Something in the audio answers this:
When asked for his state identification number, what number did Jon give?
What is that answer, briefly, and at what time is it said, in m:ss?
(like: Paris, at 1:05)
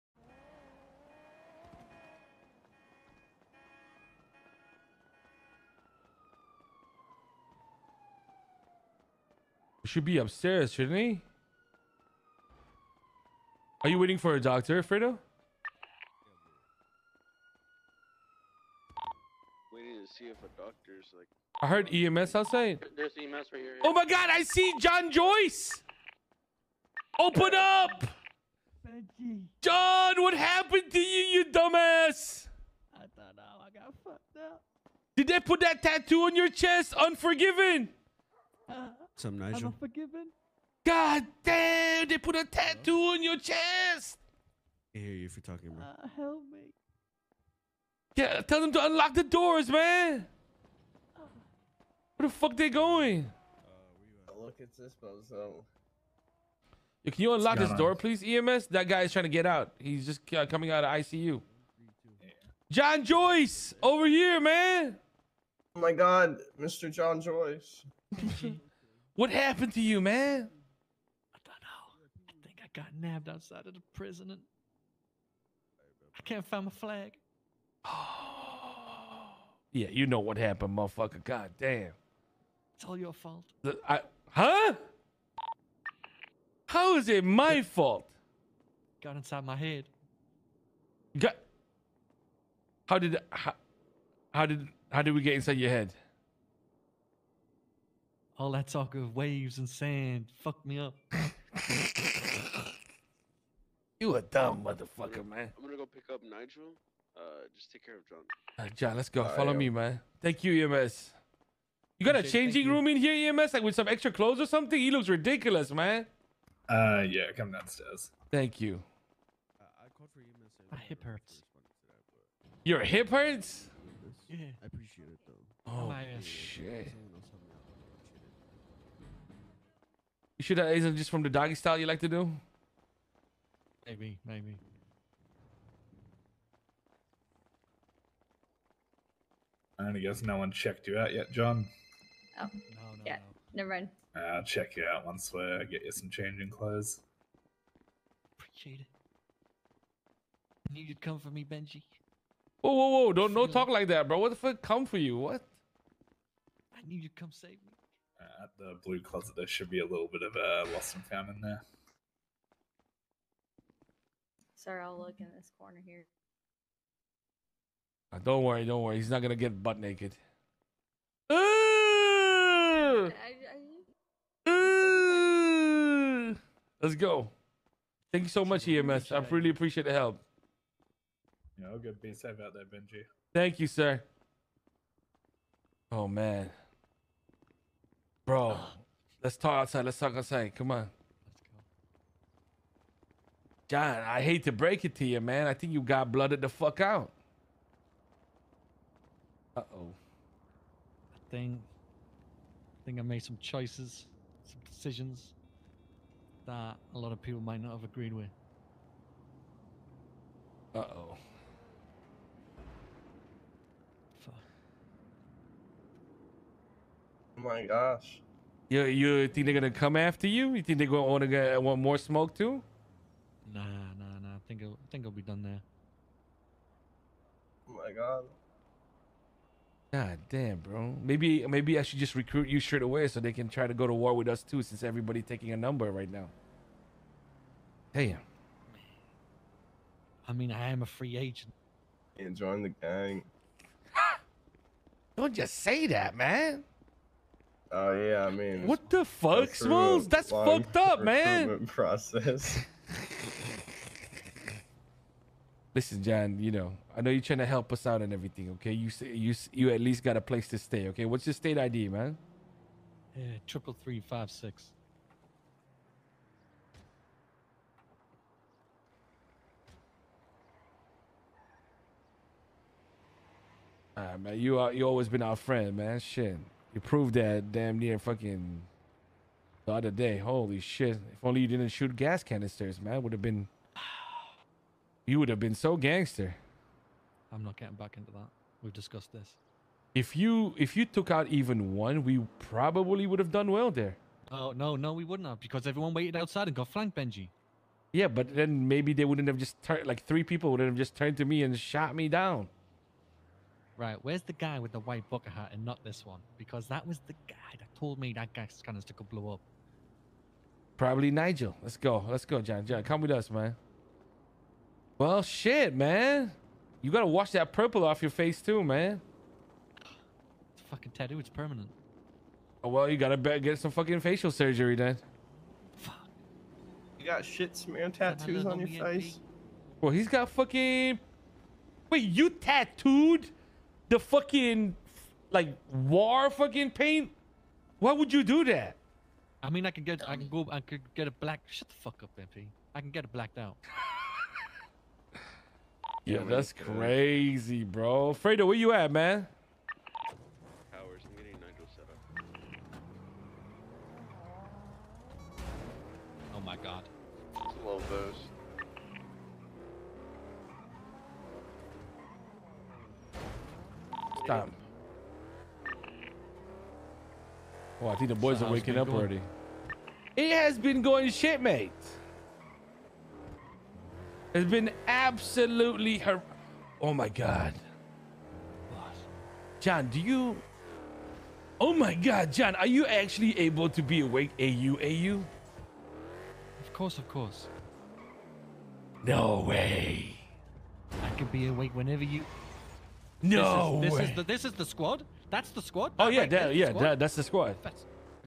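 3356, at 4:23.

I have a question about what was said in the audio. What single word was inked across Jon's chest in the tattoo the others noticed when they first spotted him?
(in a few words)
Unforgiven.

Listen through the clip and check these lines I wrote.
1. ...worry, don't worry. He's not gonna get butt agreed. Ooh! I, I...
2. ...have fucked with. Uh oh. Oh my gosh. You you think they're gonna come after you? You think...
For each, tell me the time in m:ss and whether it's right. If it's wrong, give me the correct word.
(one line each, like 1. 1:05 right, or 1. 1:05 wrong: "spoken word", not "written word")
1. 2:48 wrong: "naked", not "agreed"
2. 3:27 wrong: "agreed", not "fucked".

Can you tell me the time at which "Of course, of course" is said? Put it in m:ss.
6:26.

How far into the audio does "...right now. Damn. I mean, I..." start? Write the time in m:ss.
3:55.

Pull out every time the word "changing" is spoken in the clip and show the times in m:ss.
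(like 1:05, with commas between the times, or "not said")
1:52, 2:26.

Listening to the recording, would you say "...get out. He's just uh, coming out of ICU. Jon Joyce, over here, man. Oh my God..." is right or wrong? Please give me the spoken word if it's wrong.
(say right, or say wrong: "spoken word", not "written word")
right.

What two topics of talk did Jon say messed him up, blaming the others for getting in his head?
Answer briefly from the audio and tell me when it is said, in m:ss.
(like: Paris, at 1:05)
Waves and sand, at 1:39.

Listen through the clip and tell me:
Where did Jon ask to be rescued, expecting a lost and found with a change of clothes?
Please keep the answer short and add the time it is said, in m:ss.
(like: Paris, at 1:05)
The blue closet, at 2:38.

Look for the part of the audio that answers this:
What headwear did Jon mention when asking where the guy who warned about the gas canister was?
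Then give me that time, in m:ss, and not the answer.
5:04.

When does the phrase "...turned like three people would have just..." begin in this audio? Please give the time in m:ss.
4:59.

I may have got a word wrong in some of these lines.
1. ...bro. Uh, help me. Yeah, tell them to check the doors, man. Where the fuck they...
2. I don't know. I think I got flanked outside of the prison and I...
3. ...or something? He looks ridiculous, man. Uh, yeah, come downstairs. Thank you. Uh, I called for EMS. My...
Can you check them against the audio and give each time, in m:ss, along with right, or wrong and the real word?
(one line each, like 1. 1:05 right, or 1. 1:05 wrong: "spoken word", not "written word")
1. 0:45 wrong: "unlock", not "check"
2. 1:11 wrong: "nabbed", not "flanked"
3. 1:54 right.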